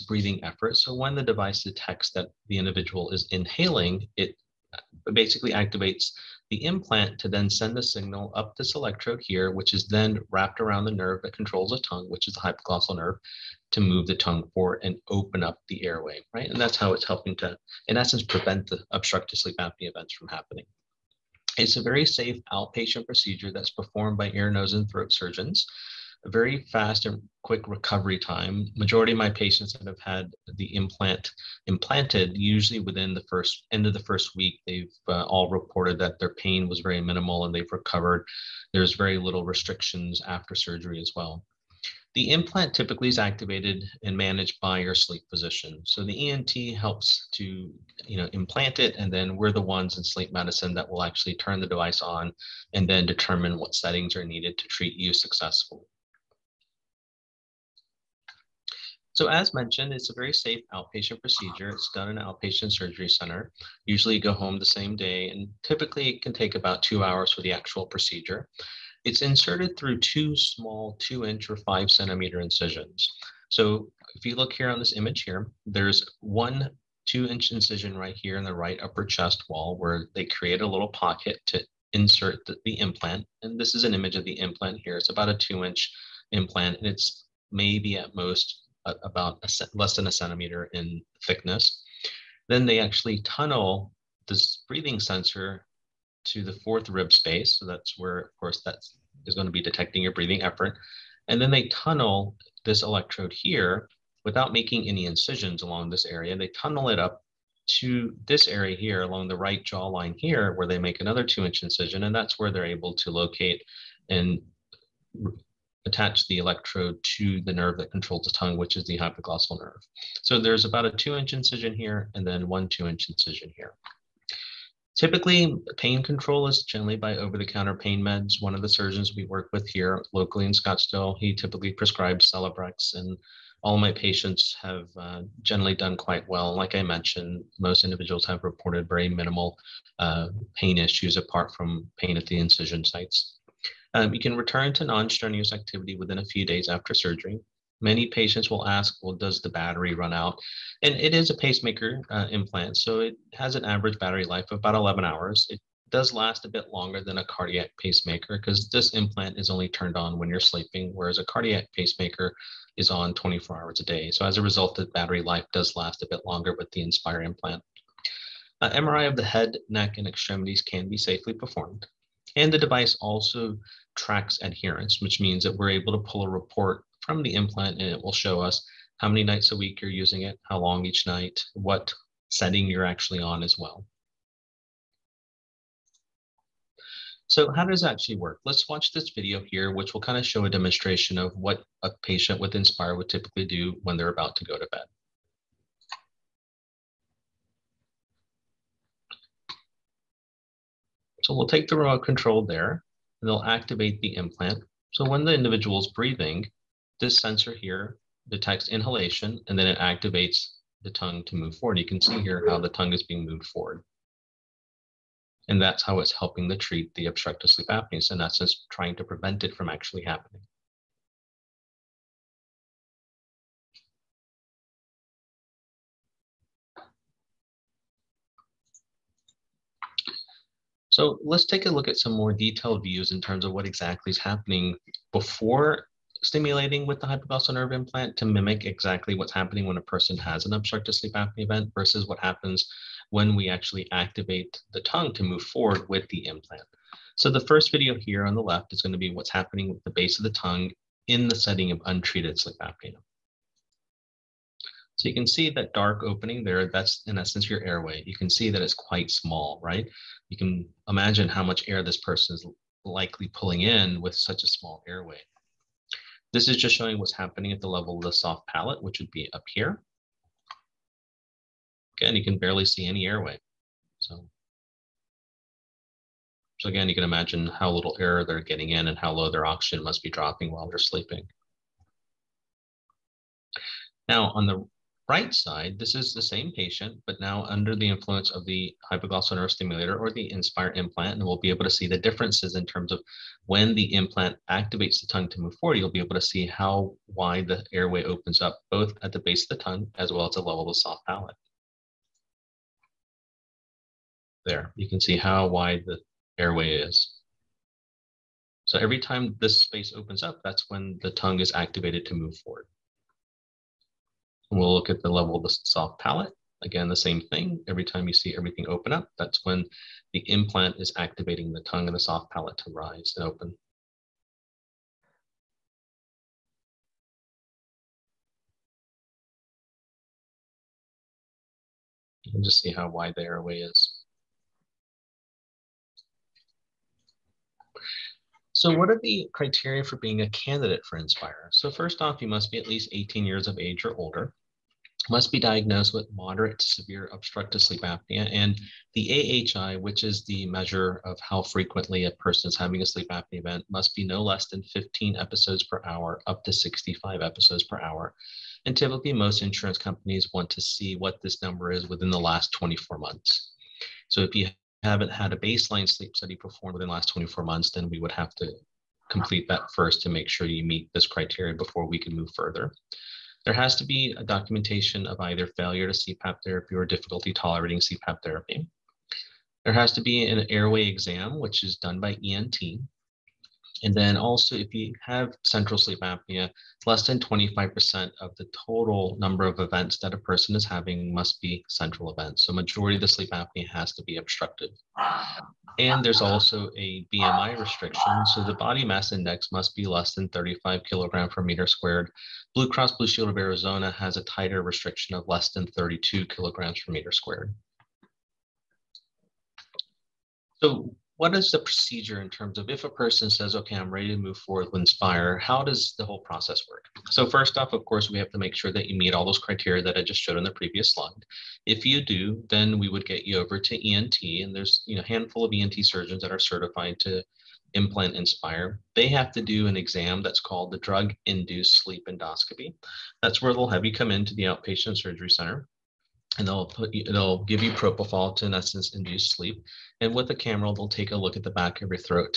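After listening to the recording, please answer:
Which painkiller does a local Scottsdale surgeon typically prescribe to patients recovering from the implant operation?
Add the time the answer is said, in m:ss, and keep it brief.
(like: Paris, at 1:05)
Celebrex, at 2:12.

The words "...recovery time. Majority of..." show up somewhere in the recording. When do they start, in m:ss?
0:27.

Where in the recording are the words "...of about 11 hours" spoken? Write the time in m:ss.
2:34.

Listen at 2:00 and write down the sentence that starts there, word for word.
So there's about a two inch incision here and then one two inch incision here.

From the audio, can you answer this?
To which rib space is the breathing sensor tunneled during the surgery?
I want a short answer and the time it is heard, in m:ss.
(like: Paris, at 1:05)
fourth rib space, at 1:36.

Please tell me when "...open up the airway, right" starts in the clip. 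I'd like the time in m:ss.
0:15.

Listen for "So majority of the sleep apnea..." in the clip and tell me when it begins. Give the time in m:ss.
6:32.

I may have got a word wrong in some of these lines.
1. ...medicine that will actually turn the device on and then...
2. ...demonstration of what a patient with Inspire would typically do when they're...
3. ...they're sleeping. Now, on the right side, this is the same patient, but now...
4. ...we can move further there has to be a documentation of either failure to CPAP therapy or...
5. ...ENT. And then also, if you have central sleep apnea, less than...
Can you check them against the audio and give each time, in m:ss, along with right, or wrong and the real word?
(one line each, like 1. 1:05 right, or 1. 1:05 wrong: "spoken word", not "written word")
1. 0:50 right
2. 3:10 right
3. 4:40 right
4. 6:11 right
5. 6:22 right.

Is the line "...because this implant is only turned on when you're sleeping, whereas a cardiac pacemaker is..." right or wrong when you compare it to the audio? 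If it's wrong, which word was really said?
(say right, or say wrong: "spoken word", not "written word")
right.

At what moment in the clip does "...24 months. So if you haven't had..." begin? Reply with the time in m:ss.
6:02.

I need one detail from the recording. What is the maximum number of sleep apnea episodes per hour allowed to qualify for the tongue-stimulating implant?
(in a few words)
65.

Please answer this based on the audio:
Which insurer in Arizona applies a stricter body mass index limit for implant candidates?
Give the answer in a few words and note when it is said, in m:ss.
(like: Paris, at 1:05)
Blue Cross Blue Shield, at 6:42.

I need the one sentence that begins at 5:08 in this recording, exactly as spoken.
So every time this space opens up, that's when the tongue is activated to move forward.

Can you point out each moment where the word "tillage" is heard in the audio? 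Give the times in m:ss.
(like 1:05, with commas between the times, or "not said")
not said.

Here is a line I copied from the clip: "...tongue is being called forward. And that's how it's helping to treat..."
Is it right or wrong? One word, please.
wrong.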